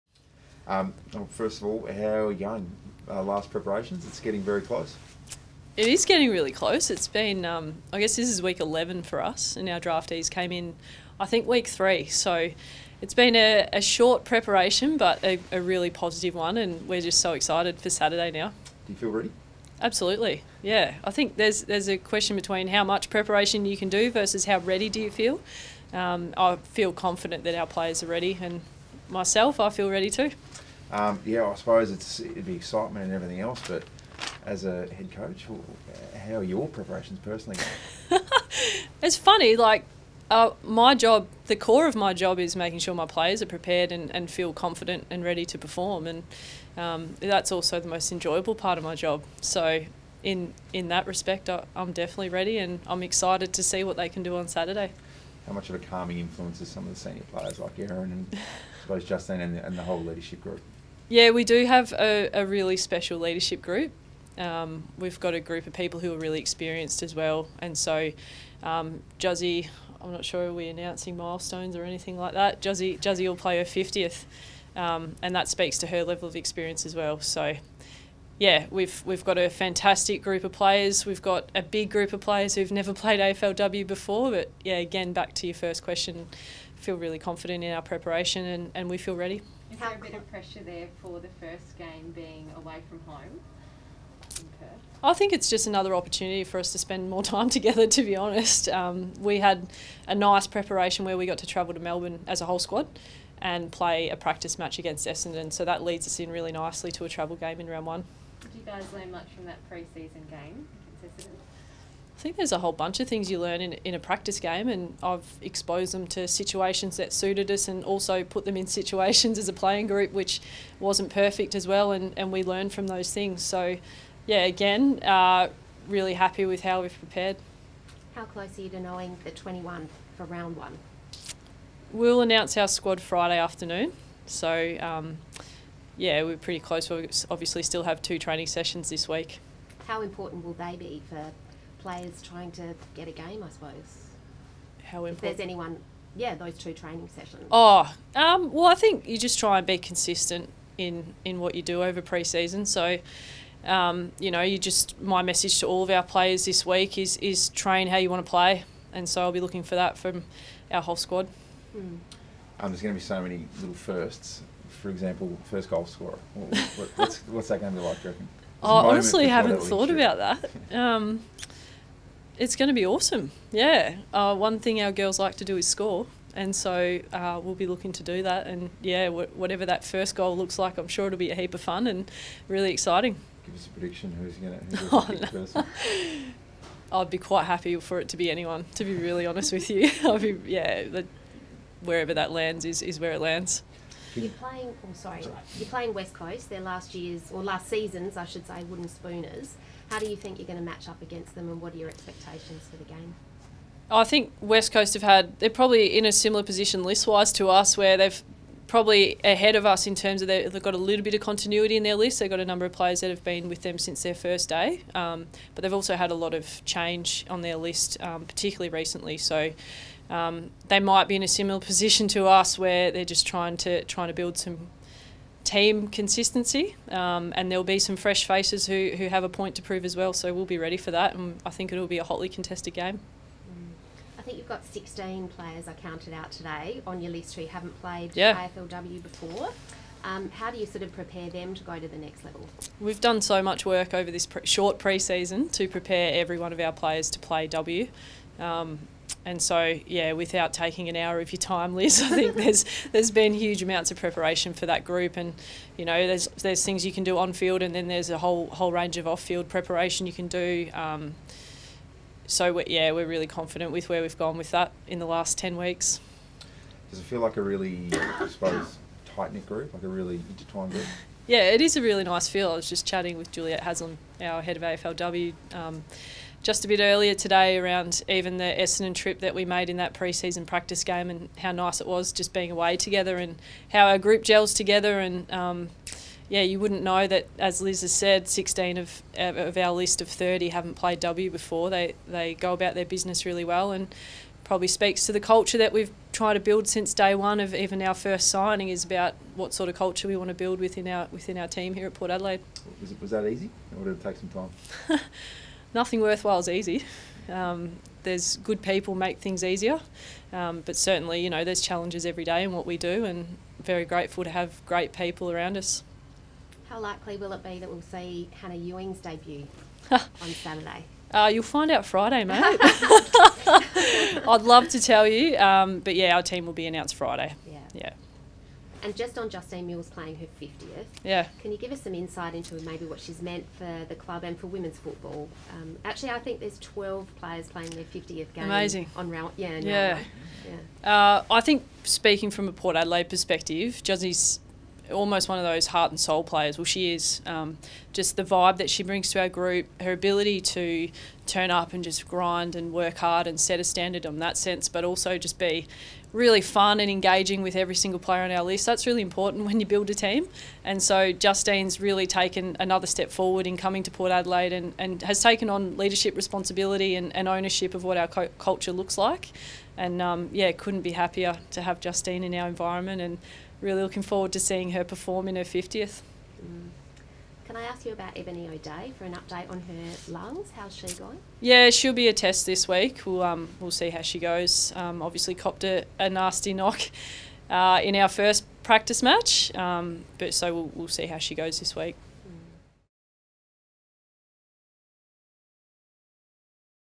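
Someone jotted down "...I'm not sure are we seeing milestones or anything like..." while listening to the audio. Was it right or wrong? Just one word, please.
wrong.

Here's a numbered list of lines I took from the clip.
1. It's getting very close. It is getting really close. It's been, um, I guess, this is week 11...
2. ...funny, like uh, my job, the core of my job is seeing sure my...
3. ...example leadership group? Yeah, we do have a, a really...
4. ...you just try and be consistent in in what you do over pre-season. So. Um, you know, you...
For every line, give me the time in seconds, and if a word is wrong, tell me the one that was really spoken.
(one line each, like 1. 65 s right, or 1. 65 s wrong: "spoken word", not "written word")
1. 4 s right
2. 39 s wrong: "making", not "seeing"
3. 59 s wrong: "whole", not "example"
4. 149 s right.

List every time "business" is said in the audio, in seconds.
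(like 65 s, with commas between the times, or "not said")
292 s.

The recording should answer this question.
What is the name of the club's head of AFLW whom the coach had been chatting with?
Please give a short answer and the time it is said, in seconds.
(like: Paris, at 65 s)
Juliet Haslam, at 273 s.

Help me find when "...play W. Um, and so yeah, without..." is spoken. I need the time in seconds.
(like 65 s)
247 s.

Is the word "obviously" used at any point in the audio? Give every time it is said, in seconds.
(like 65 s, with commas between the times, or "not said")
137 s, 385 s.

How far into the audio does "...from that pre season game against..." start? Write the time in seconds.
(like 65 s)
109 s.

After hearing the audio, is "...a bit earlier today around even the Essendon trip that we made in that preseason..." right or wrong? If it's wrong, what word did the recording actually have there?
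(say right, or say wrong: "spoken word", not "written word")
right.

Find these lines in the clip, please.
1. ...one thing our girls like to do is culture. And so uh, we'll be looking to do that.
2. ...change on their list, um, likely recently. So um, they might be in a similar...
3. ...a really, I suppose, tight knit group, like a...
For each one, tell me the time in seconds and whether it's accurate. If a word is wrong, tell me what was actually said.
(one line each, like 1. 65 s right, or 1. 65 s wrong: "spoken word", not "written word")
1. 174 s wrong: "score", not "culture"
2. 216 s wrong: "particularly", not "likely"
3. 267 s right.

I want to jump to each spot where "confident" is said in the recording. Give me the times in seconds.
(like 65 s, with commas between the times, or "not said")
26 s, 44 s, 87 s, 263 s.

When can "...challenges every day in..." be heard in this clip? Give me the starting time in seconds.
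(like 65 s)
311 s.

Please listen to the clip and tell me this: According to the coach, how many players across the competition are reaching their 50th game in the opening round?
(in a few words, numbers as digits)
12.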